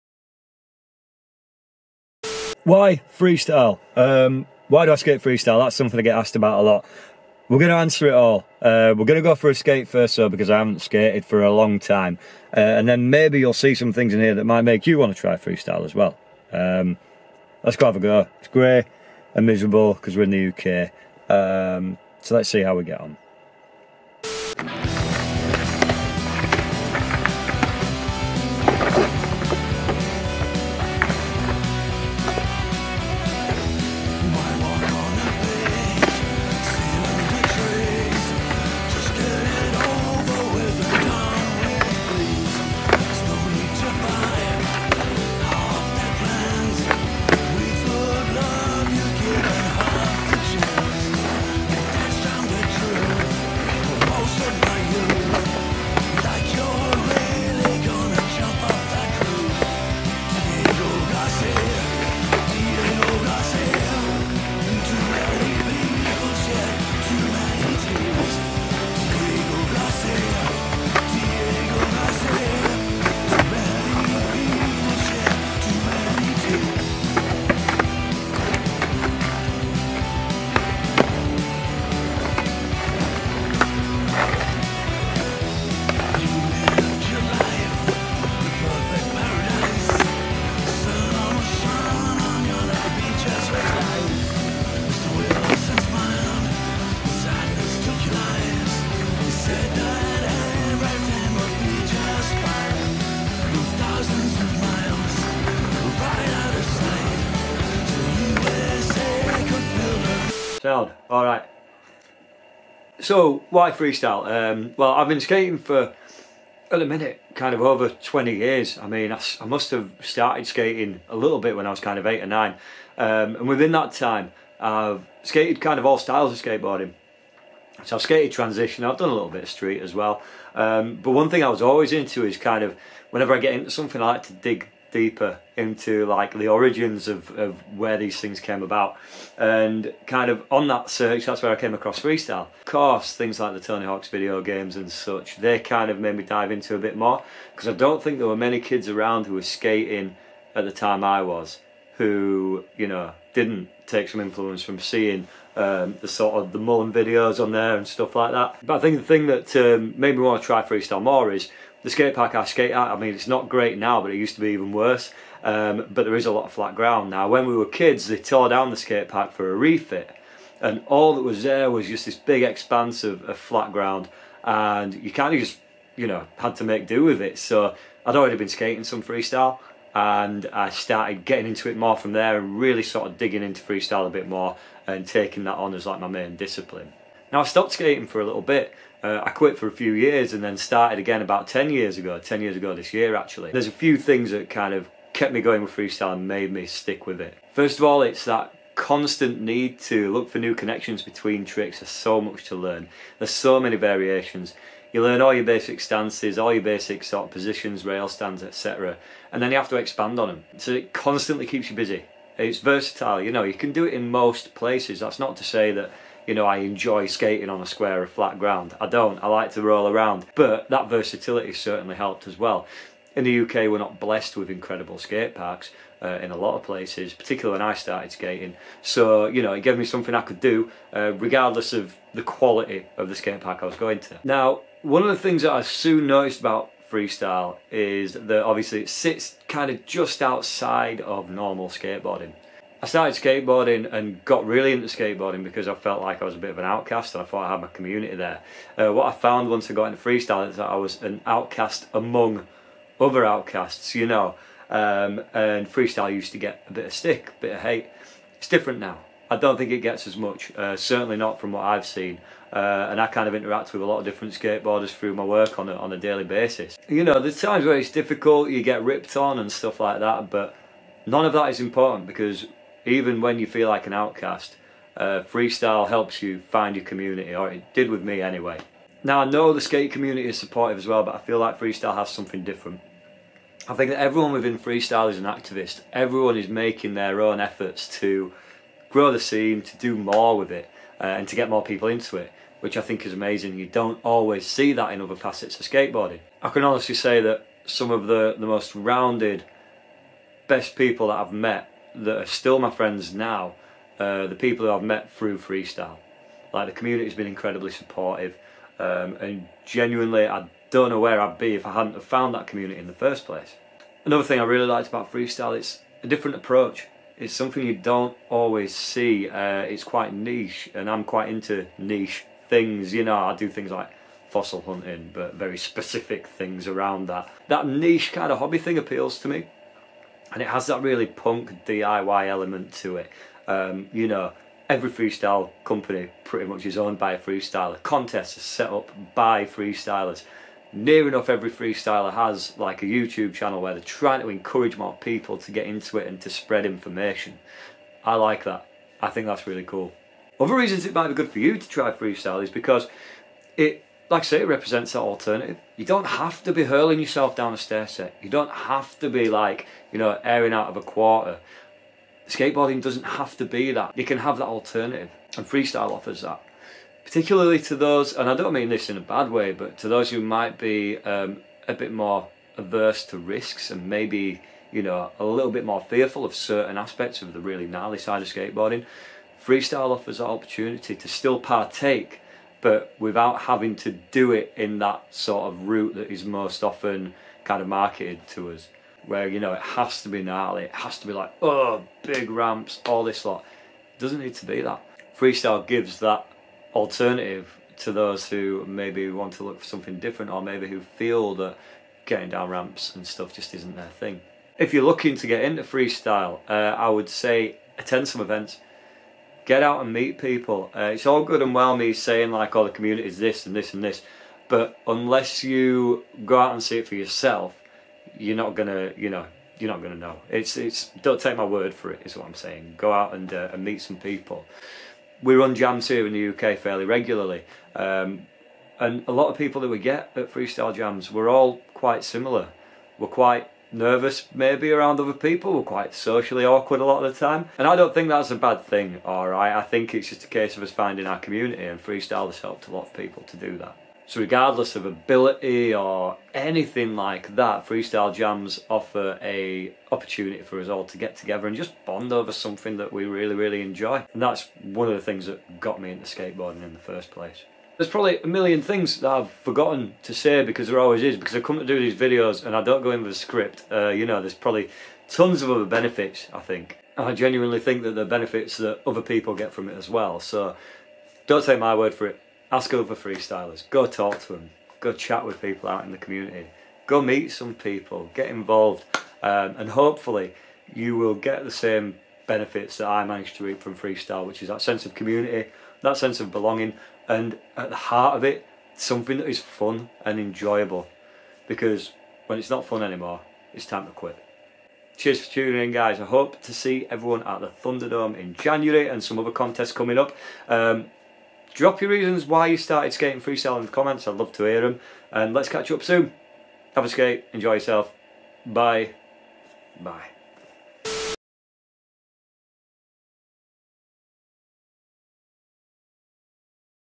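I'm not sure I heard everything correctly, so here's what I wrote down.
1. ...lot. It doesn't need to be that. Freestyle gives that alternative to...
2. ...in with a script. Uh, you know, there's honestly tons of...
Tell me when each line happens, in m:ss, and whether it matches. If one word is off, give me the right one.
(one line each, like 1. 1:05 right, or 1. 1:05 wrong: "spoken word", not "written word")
1. 6:33 right
2. 7:42 wrong: "probably", not "honestly".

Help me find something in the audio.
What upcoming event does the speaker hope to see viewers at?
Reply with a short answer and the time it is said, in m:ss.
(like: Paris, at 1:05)
Thunderdome, at 8:17.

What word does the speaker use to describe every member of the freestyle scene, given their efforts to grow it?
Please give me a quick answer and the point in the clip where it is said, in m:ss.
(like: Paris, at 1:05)
Activist, at 4:45.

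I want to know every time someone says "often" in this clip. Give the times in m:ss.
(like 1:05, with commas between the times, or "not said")
6:26.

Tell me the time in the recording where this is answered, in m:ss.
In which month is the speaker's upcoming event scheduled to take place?
8:18.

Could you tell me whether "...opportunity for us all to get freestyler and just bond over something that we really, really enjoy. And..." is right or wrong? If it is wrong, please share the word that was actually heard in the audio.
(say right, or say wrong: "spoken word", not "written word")
wrong: "together", not "freestyler".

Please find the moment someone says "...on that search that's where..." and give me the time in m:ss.
2:20.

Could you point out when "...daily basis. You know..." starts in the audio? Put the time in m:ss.
4:25.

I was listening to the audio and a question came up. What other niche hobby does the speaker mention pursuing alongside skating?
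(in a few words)
Fossil hunting.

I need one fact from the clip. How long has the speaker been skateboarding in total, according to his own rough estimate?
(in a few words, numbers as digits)
Over 20 years.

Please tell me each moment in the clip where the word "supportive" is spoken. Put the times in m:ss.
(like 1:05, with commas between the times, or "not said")
4:40, 5:07.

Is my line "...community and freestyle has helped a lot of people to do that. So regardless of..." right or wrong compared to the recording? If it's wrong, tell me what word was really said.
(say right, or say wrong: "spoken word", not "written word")
right.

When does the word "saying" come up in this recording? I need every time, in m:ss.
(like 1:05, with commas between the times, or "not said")
6:51, 7:02.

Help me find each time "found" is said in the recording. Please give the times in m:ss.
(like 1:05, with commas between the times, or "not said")
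4:09, 5:12.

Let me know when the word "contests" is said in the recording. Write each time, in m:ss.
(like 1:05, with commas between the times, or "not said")
5:37, 8:19.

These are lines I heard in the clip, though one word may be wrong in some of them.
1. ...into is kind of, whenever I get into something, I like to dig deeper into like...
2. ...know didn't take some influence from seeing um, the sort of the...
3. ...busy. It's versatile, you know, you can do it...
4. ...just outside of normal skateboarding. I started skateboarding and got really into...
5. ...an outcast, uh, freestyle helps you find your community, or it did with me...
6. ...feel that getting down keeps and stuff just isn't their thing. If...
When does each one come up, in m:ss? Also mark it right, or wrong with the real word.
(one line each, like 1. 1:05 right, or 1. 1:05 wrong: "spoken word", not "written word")
1. 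2:11 right
2. 2:32 right
3. 3:31 right
4. 3:59 right
5. 4:33 right
6. 6:40 wrong: "ramps", not "keeps".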